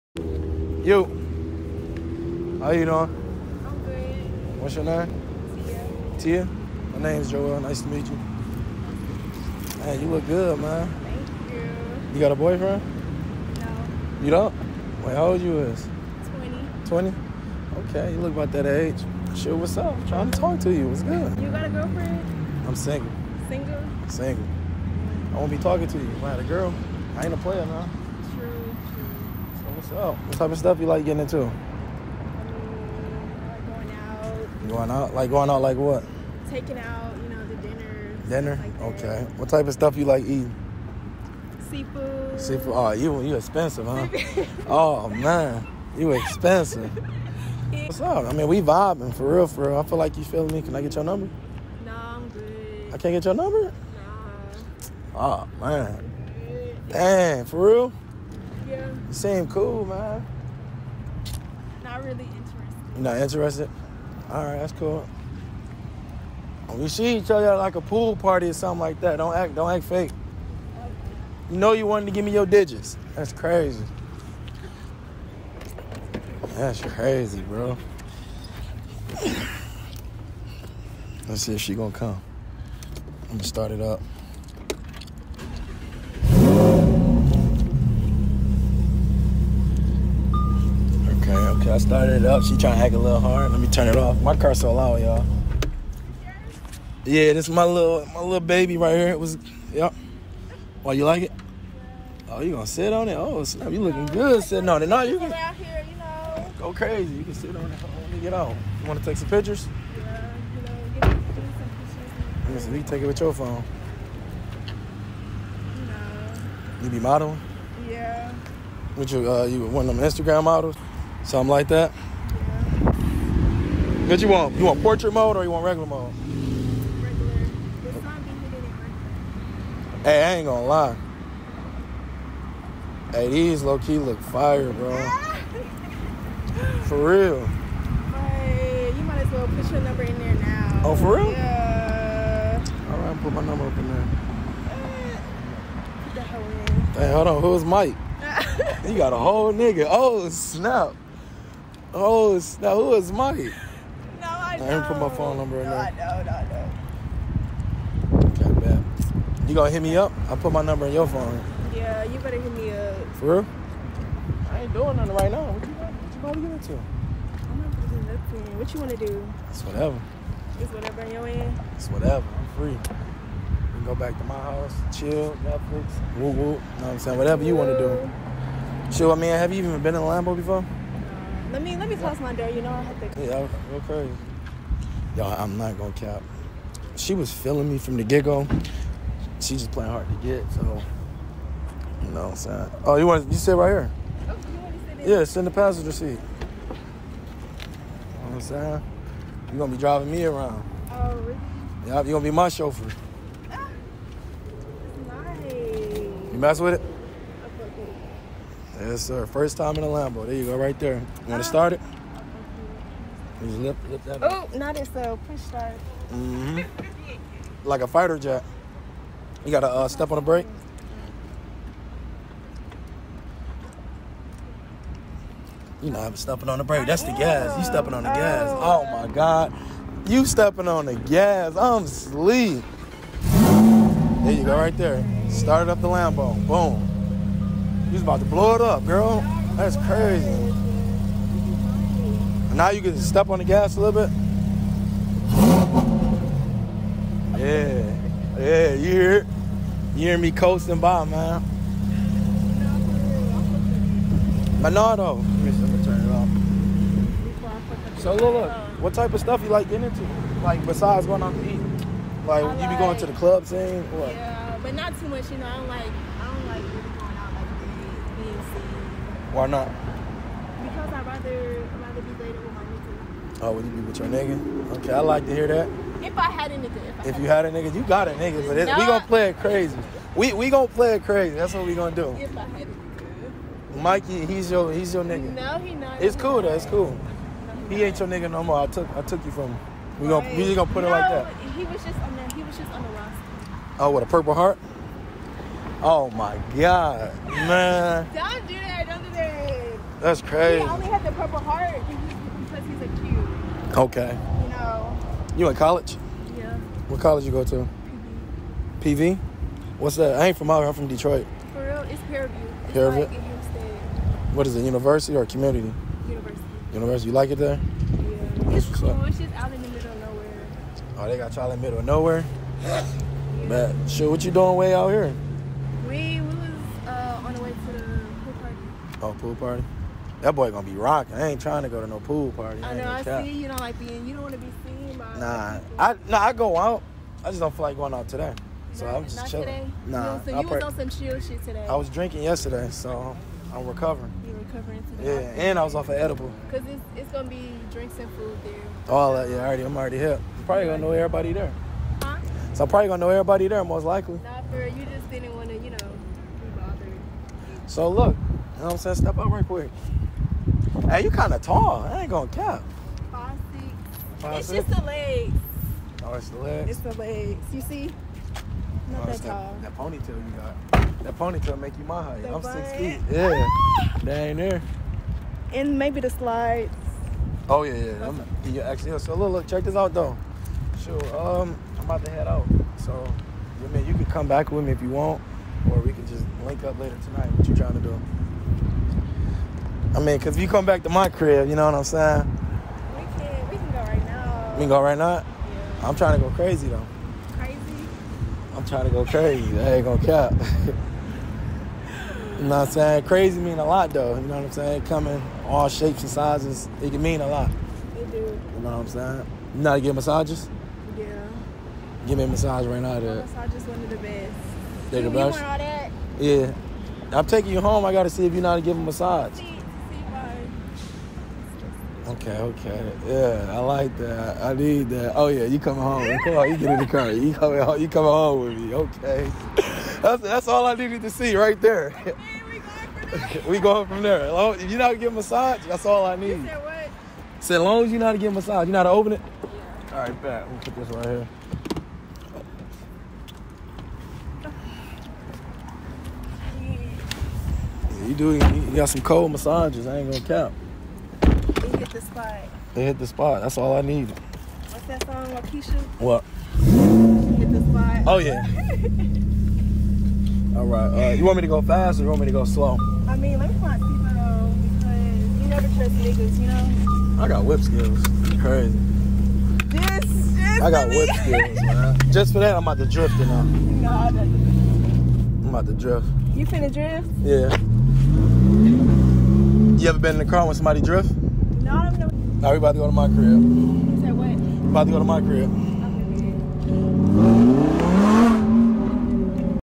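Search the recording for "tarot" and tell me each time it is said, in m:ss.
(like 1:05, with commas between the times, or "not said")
not said.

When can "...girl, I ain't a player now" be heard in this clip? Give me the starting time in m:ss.
0:26.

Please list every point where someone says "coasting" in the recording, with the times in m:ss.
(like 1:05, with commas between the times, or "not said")
4:10.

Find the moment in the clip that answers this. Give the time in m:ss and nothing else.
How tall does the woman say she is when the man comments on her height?
6:03.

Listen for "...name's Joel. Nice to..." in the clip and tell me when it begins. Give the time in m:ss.
0:07.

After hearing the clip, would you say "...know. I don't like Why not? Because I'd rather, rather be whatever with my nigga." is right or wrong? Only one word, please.
wrong.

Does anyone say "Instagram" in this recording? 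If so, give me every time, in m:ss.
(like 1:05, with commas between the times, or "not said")
2:00.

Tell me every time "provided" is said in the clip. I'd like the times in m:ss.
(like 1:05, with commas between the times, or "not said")
not said.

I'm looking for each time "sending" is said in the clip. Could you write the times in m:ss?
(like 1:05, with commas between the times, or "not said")
not said.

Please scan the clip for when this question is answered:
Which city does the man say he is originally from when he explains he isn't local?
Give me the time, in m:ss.
5:10.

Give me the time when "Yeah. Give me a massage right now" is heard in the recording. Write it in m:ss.
6:50.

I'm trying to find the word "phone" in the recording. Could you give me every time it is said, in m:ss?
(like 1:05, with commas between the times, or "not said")
1:53, 2:35, 2:41.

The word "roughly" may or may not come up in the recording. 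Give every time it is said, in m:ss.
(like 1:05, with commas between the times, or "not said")
not said.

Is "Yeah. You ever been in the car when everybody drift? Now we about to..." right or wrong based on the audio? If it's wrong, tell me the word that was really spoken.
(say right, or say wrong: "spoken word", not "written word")
wrong: "somebody", not "everybody".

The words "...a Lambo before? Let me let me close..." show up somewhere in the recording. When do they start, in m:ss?
3:00.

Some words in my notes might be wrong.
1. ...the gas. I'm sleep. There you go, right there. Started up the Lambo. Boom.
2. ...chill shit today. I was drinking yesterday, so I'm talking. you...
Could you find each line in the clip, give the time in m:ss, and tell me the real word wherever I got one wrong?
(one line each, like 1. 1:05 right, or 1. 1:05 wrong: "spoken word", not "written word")
1. 3:50 right
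2. 5:40 wrong: "recovering", not "talking".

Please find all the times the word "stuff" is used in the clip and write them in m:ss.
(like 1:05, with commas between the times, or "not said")
0:30, 0:39, 4:19.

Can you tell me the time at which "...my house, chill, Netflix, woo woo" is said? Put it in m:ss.
2:54.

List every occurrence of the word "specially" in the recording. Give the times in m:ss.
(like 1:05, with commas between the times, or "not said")
not said.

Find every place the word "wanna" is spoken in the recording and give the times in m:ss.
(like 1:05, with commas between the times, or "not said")
2:48, 2:57.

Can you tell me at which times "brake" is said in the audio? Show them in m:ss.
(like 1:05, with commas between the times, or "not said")
3:40, 3:46.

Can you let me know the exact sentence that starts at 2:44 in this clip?
I ain't doing nothing right now.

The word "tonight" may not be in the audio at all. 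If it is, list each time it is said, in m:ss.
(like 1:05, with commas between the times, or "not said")
6:27.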